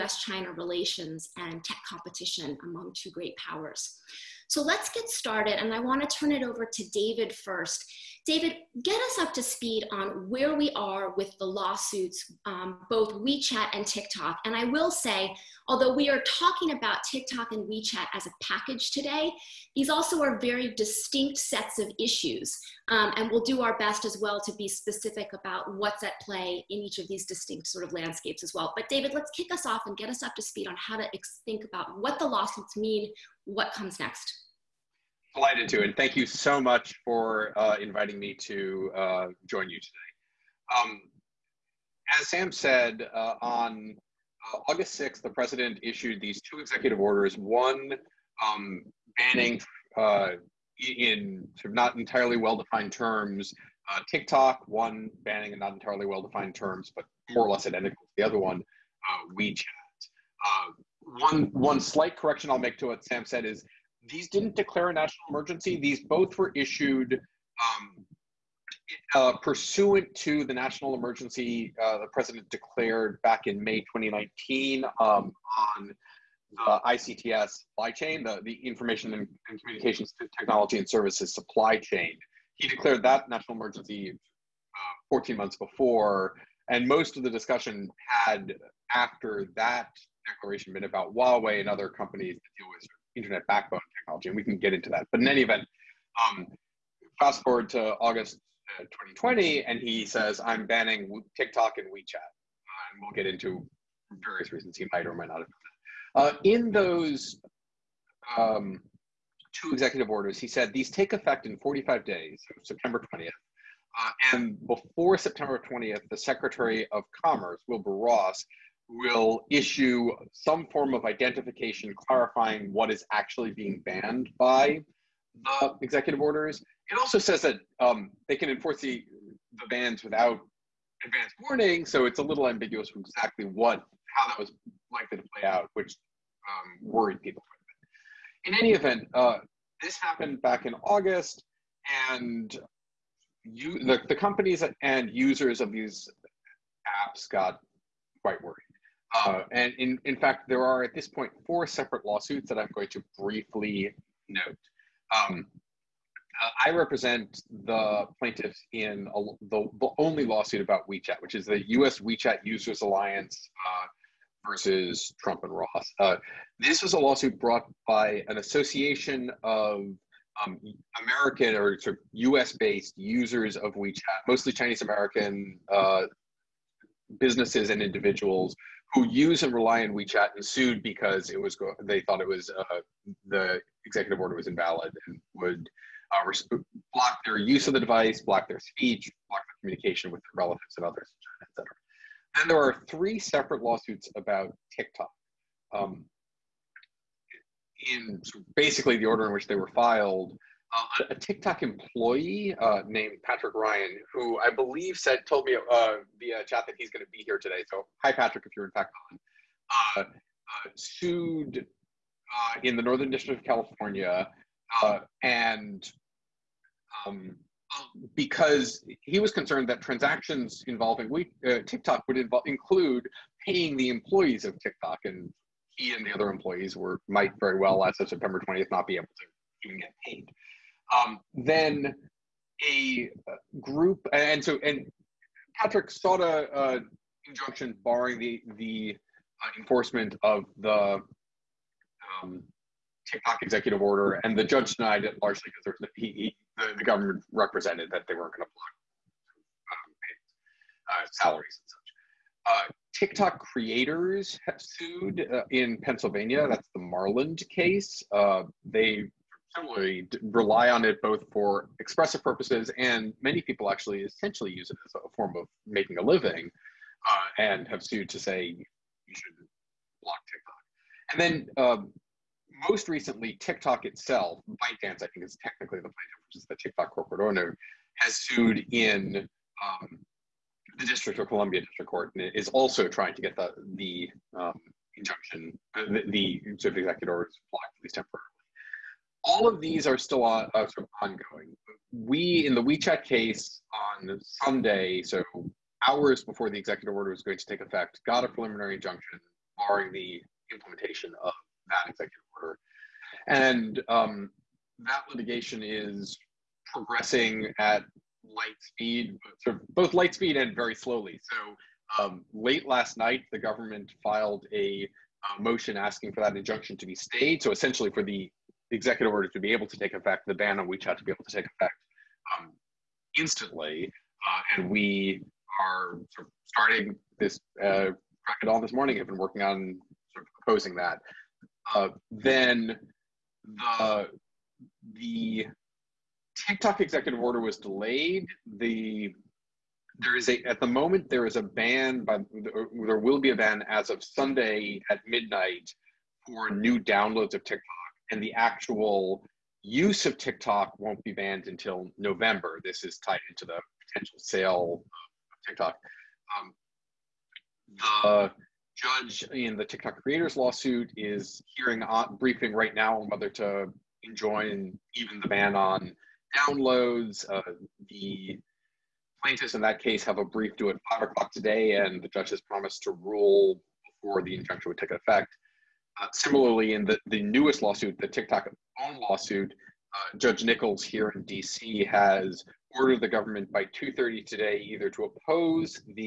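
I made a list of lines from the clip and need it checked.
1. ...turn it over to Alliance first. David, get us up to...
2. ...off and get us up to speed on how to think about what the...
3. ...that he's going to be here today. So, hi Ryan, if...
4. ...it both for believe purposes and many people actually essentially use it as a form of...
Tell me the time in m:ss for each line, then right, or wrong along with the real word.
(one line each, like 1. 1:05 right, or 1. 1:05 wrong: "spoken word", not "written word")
1. 0:06 wrong: "David", not "Alliance"
2. 0:29 right
3. 3:26 wrong: "Patrick", not "Ryan"
4. 4:20 wrong: "expressive", not "believe".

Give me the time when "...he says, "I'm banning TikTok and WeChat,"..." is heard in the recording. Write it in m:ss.
1:39.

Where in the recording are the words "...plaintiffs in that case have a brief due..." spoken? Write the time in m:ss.
6:09.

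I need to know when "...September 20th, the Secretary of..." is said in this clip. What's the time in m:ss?
1:55.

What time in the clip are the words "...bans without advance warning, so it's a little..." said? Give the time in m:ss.
2:09.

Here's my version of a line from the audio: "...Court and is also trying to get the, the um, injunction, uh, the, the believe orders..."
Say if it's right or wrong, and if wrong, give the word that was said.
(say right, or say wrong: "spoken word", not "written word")
wrong: "executive", not "believe".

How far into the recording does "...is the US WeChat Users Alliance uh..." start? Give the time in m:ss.
2:41.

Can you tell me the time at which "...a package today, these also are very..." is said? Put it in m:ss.
0:18.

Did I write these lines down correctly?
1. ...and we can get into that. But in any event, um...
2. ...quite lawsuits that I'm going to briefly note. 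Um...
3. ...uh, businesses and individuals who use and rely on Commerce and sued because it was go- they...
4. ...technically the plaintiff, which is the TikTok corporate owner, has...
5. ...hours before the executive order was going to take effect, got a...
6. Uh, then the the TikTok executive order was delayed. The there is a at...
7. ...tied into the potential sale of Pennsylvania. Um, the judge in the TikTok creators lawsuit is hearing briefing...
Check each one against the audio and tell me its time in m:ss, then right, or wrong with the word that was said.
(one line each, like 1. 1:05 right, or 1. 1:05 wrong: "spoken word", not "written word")
1. 1:34 right
2. 2:31 wrong: "separate", not "quite"
3. 2:55 wrong: "WeChat", not "Commerce"
4. 4:35 right
5. 4:55 right
6. 5:31 right
7. 5:52 wrong: "TikTok", not "Pennsylvania".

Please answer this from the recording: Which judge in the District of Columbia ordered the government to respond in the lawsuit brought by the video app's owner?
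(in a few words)
Judge Nichols.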